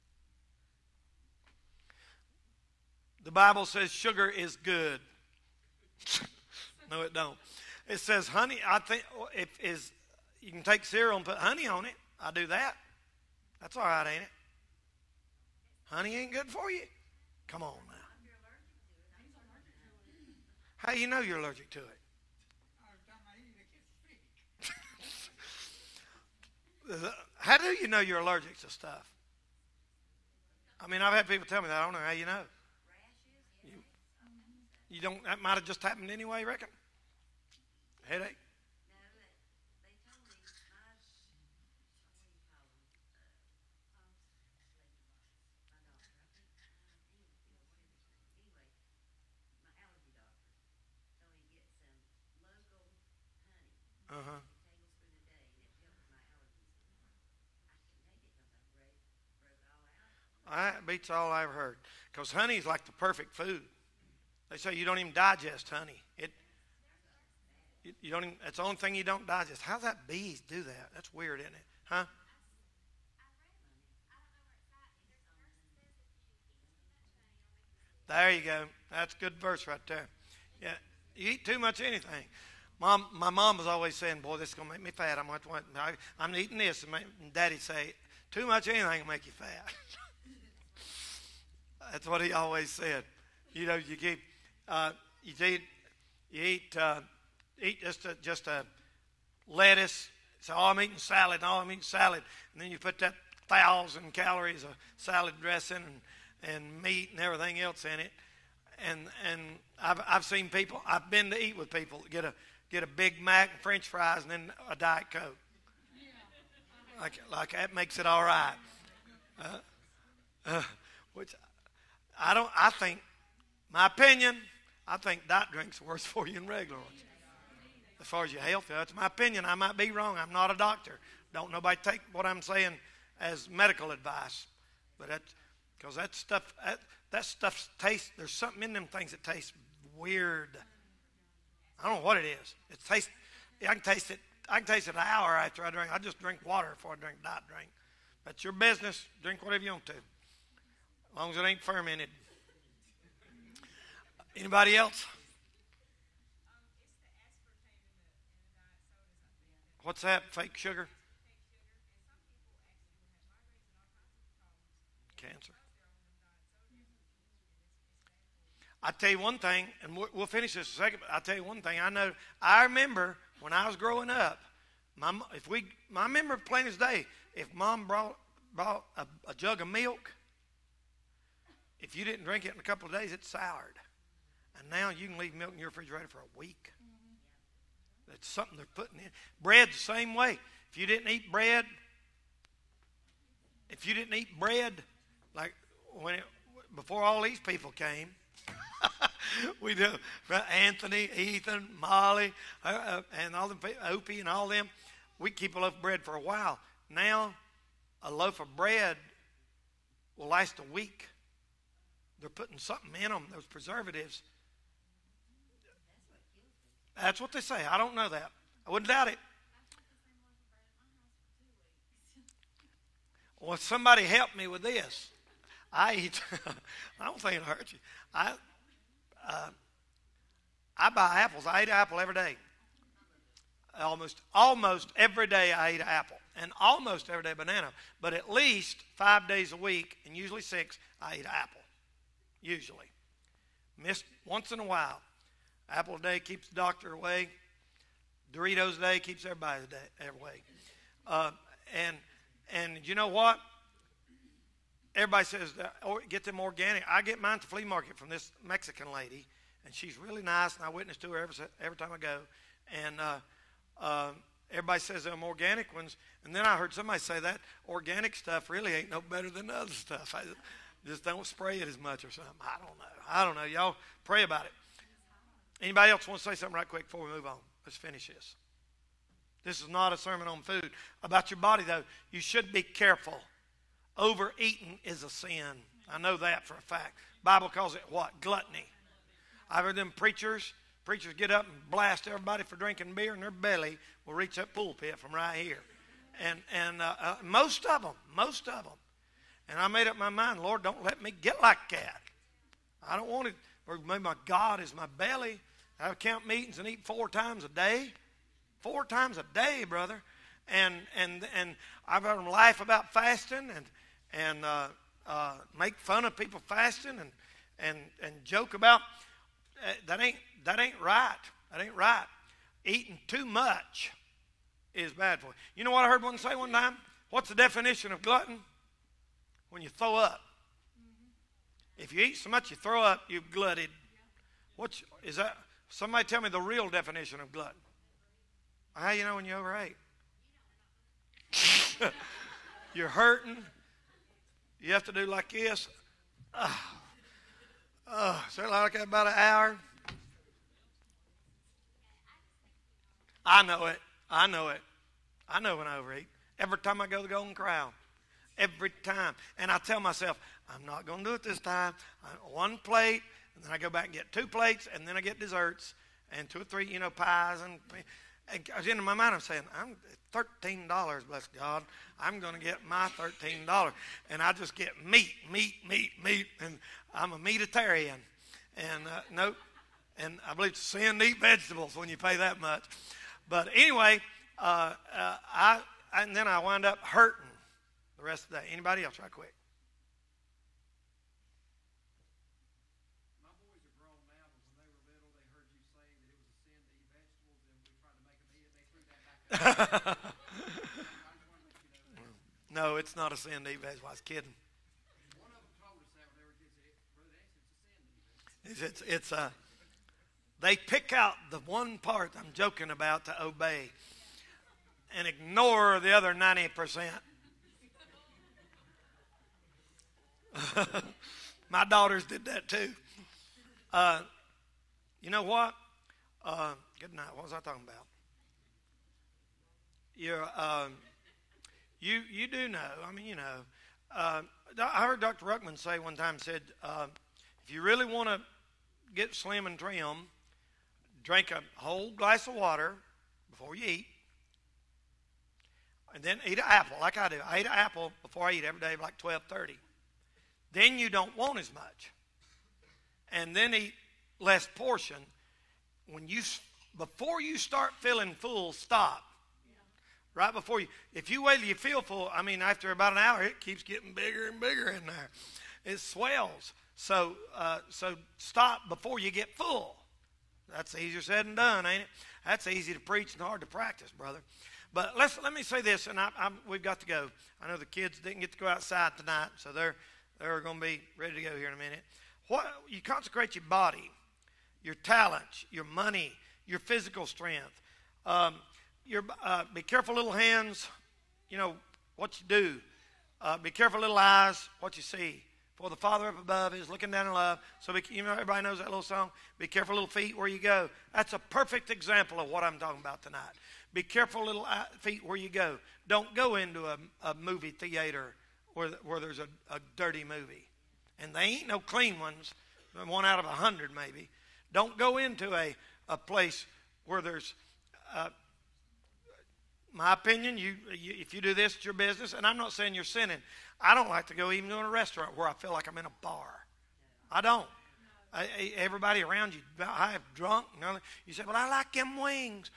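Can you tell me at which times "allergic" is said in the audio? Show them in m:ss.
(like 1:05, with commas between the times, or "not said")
0:21, 0:28.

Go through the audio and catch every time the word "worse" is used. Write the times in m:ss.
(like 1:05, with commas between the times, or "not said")
2:05.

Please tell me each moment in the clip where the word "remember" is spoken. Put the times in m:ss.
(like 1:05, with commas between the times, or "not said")
2:52.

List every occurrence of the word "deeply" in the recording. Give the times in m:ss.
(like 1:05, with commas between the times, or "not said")
not said.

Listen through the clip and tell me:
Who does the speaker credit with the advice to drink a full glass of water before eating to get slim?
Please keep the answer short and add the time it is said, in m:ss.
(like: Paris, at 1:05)
Dr. Ruckman, at 7:14.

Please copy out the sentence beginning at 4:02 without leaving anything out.
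Usually, miss once in a while.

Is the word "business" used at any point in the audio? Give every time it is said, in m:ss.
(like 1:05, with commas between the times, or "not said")
2:28, 8:41.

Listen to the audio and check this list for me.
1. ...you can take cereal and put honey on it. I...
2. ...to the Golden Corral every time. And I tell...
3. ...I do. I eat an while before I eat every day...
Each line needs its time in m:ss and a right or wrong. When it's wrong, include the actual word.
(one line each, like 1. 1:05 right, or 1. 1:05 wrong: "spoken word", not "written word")
1. 0:10 right
2. 5:56 right
3. 7:26 wrong: "apple", not "while".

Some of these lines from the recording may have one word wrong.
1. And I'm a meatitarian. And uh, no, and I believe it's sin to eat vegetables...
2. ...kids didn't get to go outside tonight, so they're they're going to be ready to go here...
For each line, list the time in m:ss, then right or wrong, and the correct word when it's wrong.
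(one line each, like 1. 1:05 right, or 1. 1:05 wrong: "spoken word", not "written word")
1. 6:16 right
2. 7:57 right.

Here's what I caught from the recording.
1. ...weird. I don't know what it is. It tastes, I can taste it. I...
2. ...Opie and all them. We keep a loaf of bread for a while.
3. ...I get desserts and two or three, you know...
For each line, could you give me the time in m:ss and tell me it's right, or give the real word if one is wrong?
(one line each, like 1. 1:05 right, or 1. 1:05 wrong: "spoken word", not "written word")
1. 2:19 right
2. 3:23 right
3. 6:04 right.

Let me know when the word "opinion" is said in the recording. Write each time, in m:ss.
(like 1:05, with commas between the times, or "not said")
2:03, 2:09, 8:39.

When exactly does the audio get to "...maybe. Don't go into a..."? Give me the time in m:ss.
8:33.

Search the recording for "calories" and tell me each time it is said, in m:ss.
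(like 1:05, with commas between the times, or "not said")
1:44.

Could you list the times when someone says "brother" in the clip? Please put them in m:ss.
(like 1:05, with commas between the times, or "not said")
5:09, 7:53.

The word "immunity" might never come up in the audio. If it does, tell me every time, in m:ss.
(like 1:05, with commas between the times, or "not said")
not said.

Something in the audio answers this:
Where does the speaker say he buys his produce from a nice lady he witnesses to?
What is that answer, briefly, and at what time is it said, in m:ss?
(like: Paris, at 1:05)
flea market, at 4:17.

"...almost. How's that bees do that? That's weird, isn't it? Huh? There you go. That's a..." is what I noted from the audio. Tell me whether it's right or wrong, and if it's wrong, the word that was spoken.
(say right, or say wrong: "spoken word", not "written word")
wrong: "digest", not "almost".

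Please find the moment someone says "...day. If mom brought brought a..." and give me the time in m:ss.
2:56.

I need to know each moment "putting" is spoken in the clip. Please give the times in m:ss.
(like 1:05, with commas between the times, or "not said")
3:08, 3:32.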